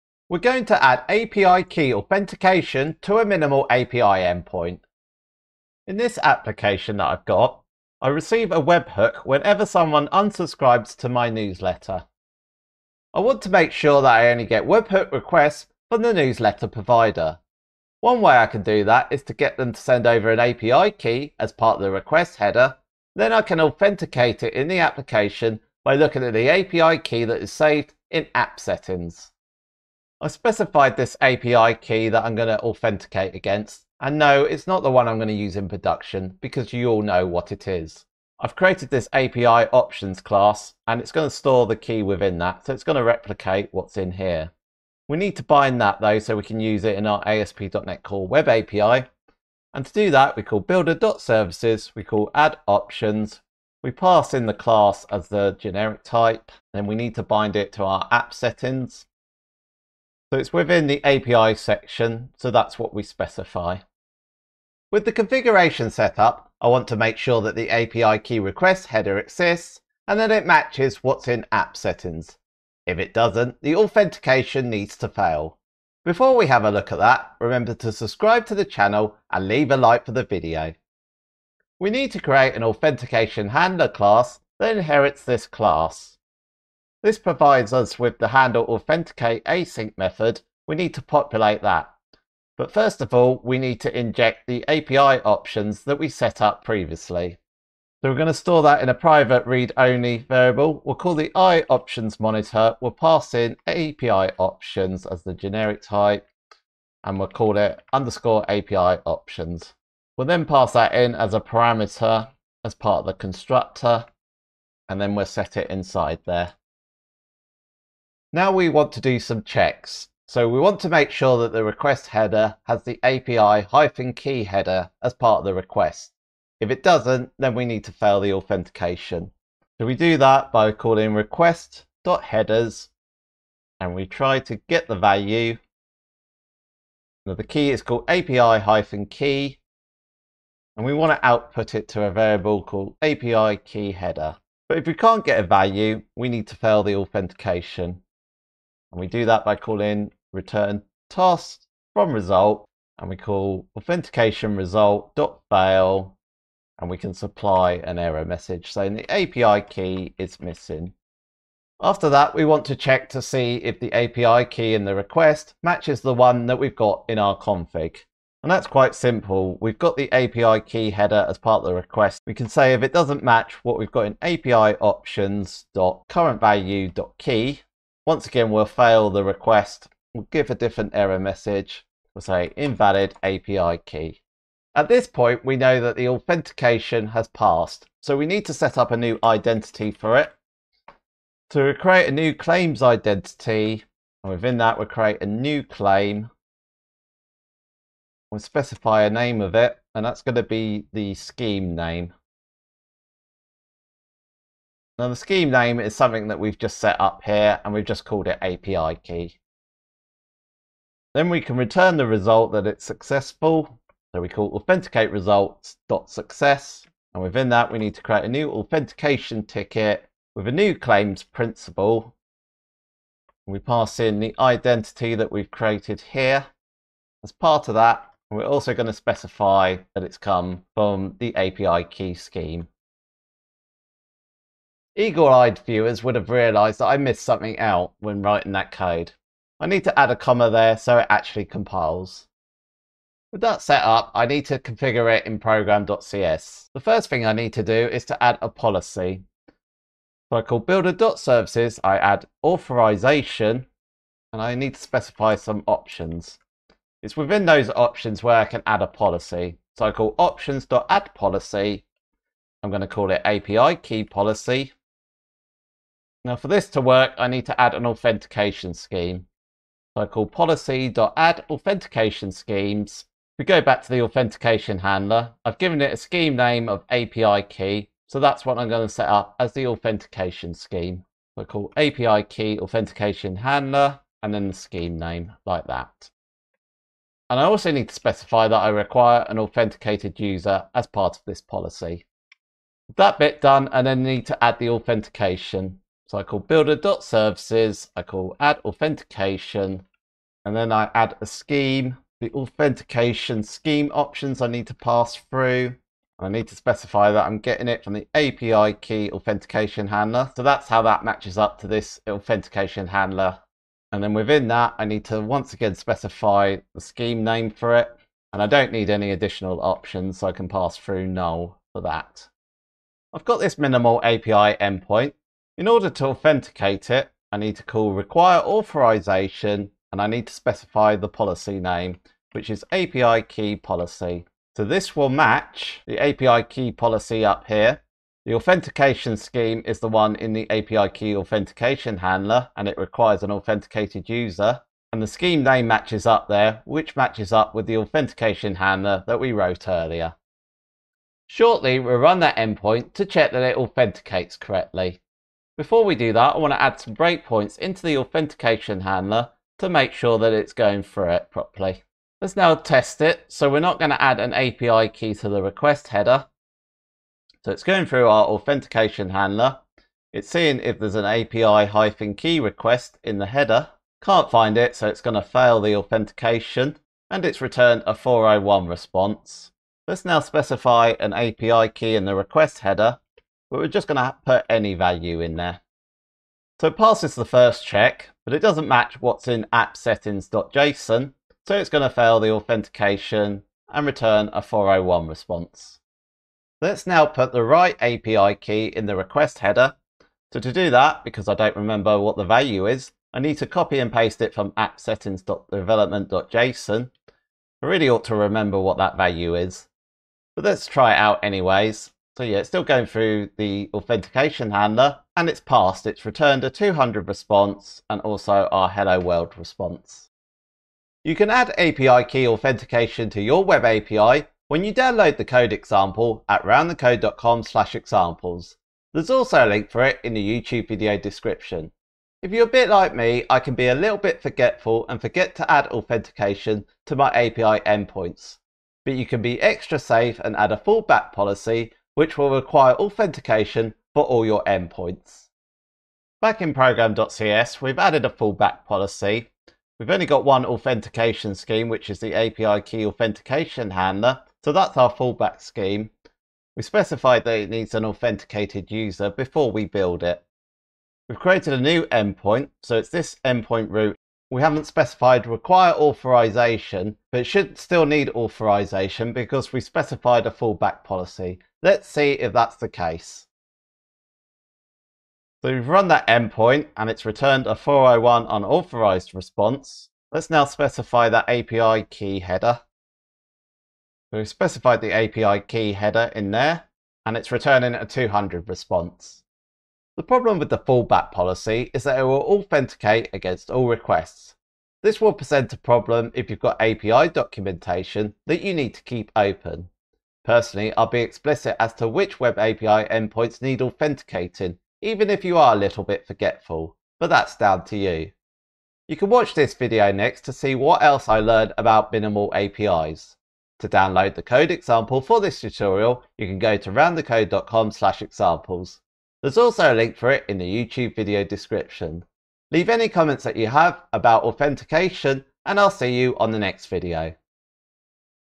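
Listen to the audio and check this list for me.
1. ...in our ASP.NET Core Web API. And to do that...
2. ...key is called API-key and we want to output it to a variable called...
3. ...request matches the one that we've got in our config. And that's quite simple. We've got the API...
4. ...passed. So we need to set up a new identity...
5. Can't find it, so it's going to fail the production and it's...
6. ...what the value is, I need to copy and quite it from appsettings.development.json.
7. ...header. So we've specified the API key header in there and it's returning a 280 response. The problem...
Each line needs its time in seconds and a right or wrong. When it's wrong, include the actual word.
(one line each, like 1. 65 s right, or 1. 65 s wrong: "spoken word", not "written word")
1. 46 s right
2. 137 s right
3. 164 s right
4. 187 s right
5. 374 s wrong: "authentication", not "production"
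6. 401 s wrong: "paste", not "quite"
7. 482 s wrong: "200", not "280".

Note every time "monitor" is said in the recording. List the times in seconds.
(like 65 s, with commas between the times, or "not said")
102 s.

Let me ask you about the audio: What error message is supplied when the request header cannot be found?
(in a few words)
API key is missing.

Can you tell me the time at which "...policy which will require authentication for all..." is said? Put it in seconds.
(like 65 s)
441 s.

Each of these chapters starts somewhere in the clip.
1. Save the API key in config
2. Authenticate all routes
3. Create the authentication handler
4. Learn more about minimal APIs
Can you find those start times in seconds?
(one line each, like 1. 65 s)
1. 29 s
2. 420 s
3. 64 s
4. 488 s.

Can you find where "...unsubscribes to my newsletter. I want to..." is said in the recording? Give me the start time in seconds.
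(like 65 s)
10 s.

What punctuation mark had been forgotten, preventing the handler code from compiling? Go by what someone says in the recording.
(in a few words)
A comma.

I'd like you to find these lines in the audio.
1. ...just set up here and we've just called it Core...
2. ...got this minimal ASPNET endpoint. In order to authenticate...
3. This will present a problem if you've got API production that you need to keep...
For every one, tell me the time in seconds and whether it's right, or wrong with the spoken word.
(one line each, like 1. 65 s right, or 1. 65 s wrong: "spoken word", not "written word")
1. 206 s wrong: "API", not "Core"
2. 323 s wrong: "API", not "ASPNET"
3. 494 s wrong: "documentation", not "production".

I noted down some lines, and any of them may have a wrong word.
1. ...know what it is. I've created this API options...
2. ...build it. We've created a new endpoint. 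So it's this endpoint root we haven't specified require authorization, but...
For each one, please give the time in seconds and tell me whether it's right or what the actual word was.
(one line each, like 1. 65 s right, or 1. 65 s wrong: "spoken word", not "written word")
1. 37 s right
2. 459 s right.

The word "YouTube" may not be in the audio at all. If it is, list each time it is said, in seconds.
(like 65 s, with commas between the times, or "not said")
430 s, 520 s.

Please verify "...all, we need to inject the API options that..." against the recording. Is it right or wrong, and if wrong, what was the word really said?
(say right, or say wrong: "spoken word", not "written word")
right.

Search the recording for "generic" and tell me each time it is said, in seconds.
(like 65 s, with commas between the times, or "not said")
55 s, 105 s.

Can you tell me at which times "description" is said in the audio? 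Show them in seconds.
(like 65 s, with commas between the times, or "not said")
430 s, 521 s.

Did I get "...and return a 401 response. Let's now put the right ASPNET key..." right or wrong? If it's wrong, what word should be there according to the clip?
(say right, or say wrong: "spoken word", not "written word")
wrong: "API", not "ASPNET".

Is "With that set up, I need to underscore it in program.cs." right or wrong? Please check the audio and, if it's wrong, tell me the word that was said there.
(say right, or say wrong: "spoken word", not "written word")
wrong: "configure", not "underscore".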